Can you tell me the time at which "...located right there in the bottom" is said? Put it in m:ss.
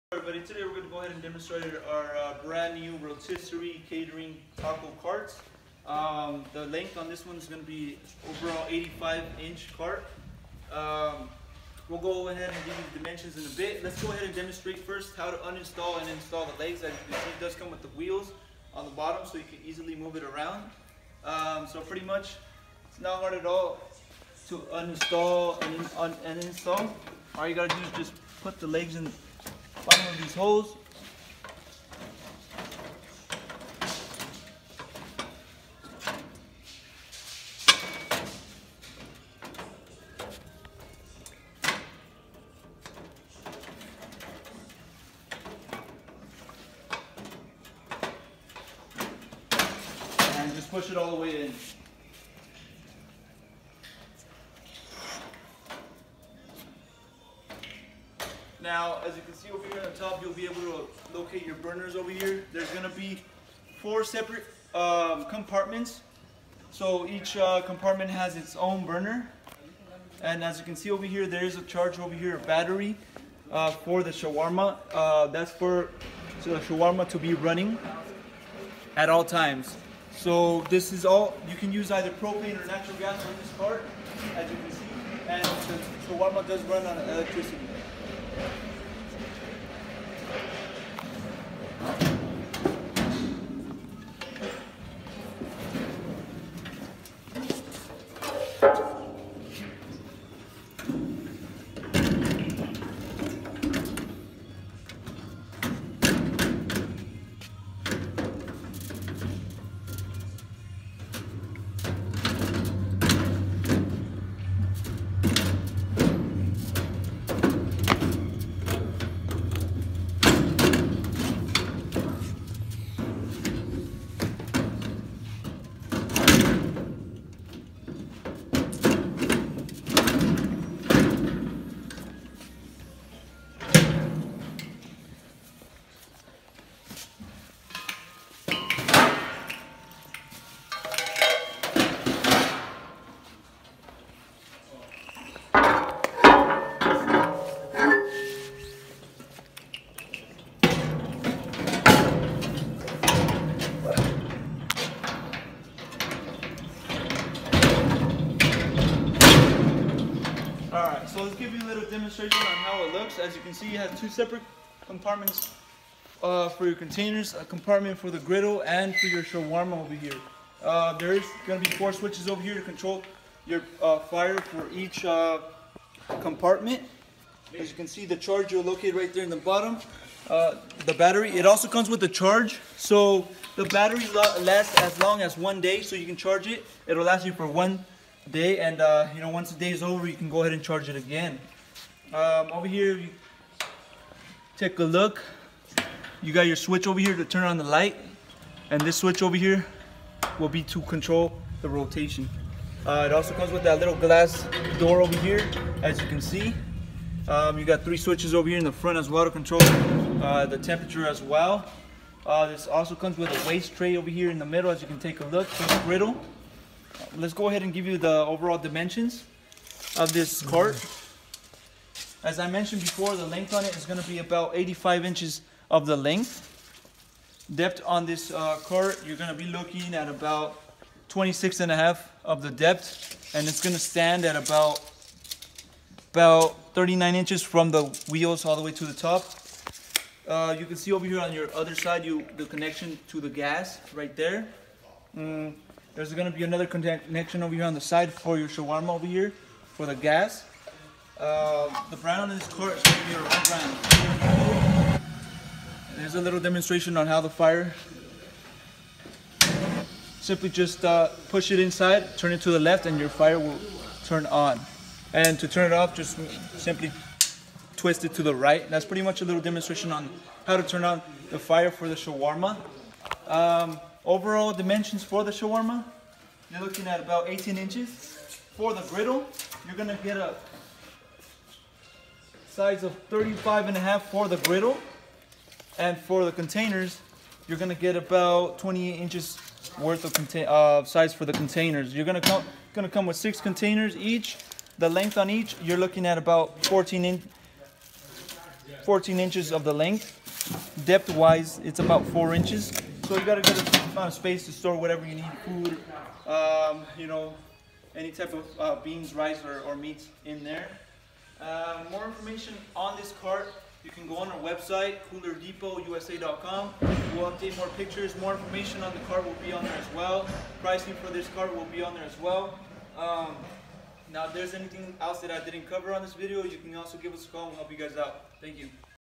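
2:58.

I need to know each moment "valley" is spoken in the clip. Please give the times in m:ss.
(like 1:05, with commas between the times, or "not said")
not said.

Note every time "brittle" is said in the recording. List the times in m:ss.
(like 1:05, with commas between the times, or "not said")
3:35.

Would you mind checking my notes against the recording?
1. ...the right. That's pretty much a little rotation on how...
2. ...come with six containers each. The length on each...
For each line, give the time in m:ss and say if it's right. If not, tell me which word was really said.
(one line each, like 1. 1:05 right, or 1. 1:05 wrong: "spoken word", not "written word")
1. 4:28 wrong: "demonstration", not "rotation"
2. 4:52 right.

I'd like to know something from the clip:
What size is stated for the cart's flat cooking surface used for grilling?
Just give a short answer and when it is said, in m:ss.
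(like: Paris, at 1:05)
35.5 inches, at 4:43.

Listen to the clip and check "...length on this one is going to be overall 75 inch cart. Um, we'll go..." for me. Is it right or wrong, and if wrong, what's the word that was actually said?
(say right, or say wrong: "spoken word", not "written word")
wrong: "85", not "75".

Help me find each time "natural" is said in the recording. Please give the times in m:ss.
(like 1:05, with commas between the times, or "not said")
1:22.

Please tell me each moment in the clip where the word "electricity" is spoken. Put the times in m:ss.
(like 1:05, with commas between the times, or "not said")
1:27.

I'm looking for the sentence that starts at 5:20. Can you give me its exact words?
Pricing for this cart will be on there as well.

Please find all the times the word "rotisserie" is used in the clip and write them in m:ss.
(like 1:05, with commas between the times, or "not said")
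0:03.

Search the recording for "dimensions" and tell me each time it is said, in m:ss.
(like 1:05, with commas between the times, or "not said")
0:12, 3:38, 4:34.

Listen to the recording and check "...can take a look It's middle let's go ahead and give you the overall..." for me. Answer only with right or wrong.
wrong.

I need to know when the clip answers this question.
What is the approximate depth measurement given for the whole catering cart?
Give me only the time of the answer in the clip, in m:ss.
3:51.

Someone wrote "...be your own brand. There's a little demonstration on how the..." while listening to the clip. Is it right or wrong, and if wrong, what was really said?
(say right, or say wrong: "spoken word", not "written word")
right.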